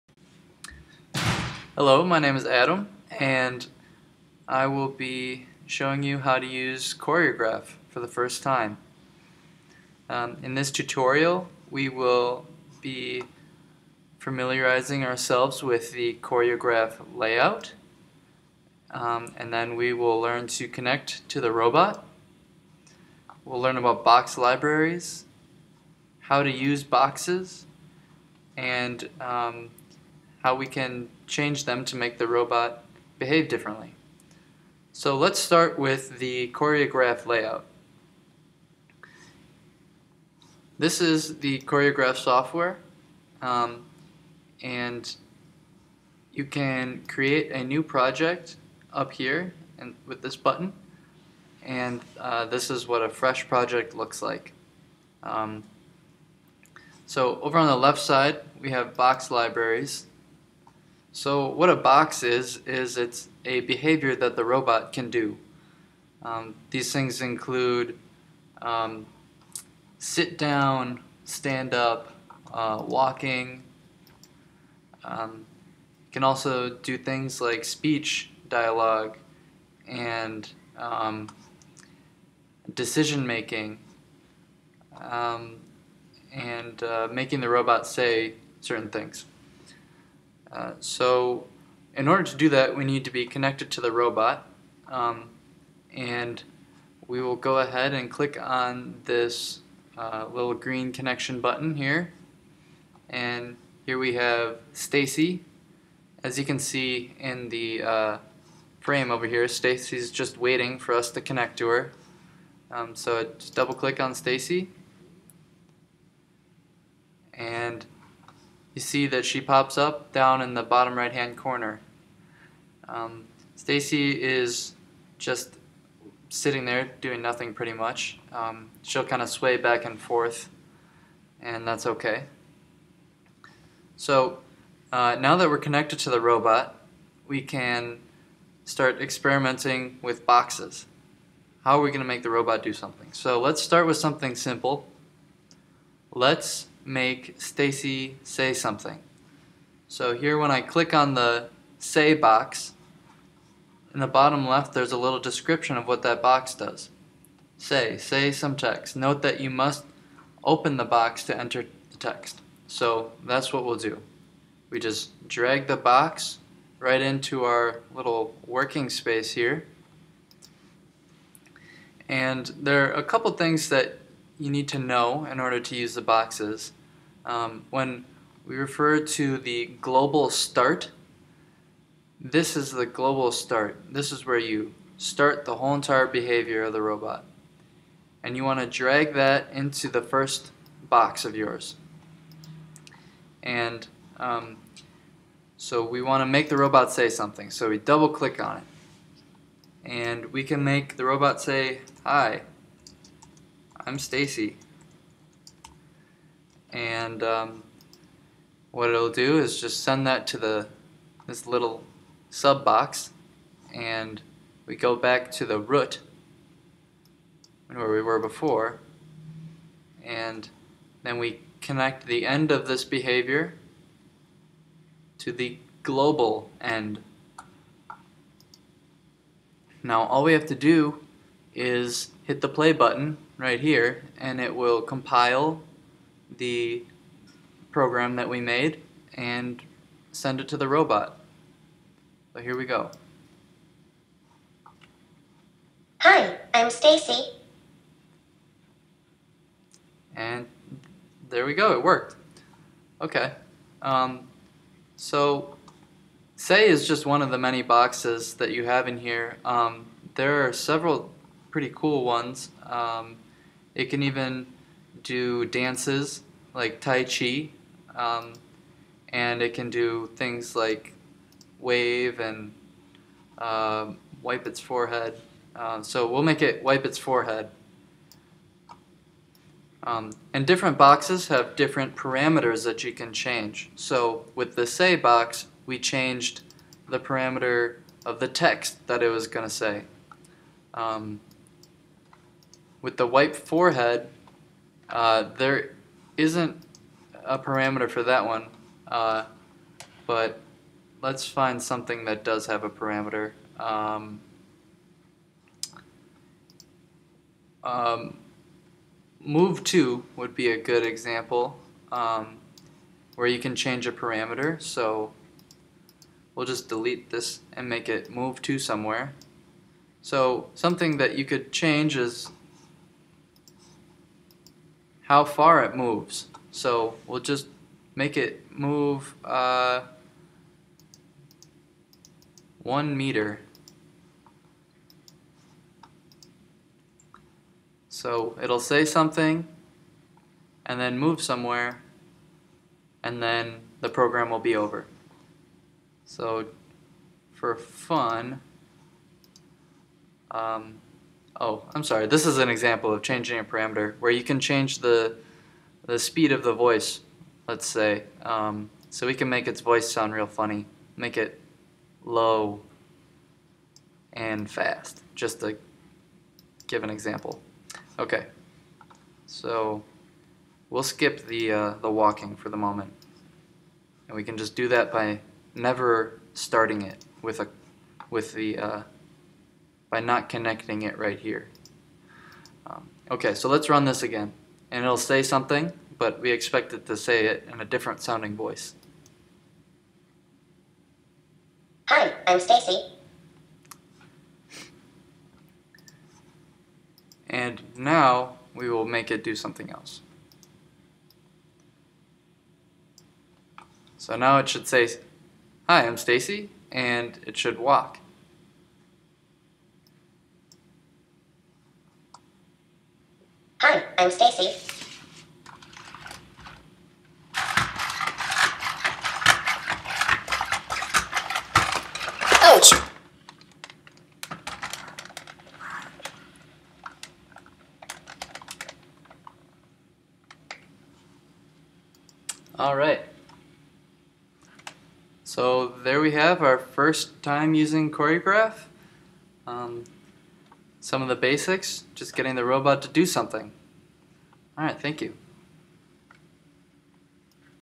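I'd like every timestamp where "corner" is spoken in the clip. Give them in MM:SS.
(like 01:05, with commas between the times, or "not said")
02:01.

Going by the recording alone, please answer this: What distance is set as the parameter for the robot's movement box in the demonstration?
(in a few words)
1 meter.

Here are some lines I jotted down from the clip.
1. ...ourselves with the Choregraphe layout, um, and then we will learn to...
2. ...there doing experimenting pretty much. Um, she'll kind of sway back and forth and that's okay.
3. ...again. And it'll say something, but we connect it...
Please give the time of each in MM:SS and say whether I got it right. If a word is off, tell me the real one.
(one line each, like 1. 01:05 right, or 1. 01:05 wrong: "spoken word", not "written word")
1. 00:15 right
2. 02:06 wrong: "nothing", not "experimenting"
3. 06:24 wrong: "expect", not "connect".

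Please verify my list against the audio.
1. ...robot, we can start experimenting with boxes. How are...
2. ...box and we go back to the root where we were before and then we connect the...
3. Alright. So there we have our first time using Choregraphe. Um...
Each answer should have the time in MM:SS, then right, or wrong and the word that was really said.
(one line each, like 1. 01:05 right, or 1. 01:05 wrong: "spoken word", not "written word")
1. 02:16 right
2. 03:32 right
3. 07:12 right.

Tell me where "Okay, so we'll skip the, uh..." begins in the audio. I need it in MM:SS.
06:07.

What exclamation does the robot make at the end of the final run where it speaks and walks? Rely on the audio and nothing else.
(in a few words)
Ouch!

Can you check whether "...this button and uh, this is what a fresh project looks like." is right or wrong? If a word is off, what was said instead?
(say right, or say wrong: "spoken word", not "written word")
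right.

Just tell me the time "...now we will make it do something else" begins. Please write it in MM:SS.
06:37.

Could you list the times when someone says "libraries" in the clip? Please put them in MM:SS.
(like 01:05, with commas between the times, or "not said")
00:24, 00:59.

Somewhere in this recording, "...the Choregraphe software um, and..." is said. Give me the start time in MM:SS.
00:41.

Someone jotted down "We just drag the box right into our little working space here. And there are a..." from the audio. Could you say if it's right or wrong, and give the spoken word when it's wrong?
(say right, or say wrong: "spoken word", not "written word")
right.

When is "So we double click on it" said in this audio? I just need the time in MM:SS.
03:17.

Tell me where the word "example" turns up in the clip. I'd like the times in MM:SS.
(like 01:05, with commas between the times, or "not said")
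05:10, 05:52, 06:06.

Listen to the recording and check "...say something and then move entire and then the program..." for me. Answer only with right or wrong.
wrong.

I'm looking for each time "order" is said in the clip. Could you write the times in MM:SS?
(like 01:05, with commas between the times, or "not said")
01:32, 02:55.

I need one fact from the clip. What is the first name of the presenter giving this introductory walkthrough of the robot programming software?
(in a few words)
Adam.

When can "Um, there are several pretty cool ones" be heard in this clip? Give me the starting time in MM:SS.
04:19.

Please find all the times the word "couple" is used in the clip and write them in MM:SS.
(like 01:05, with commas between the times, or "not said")
02:53.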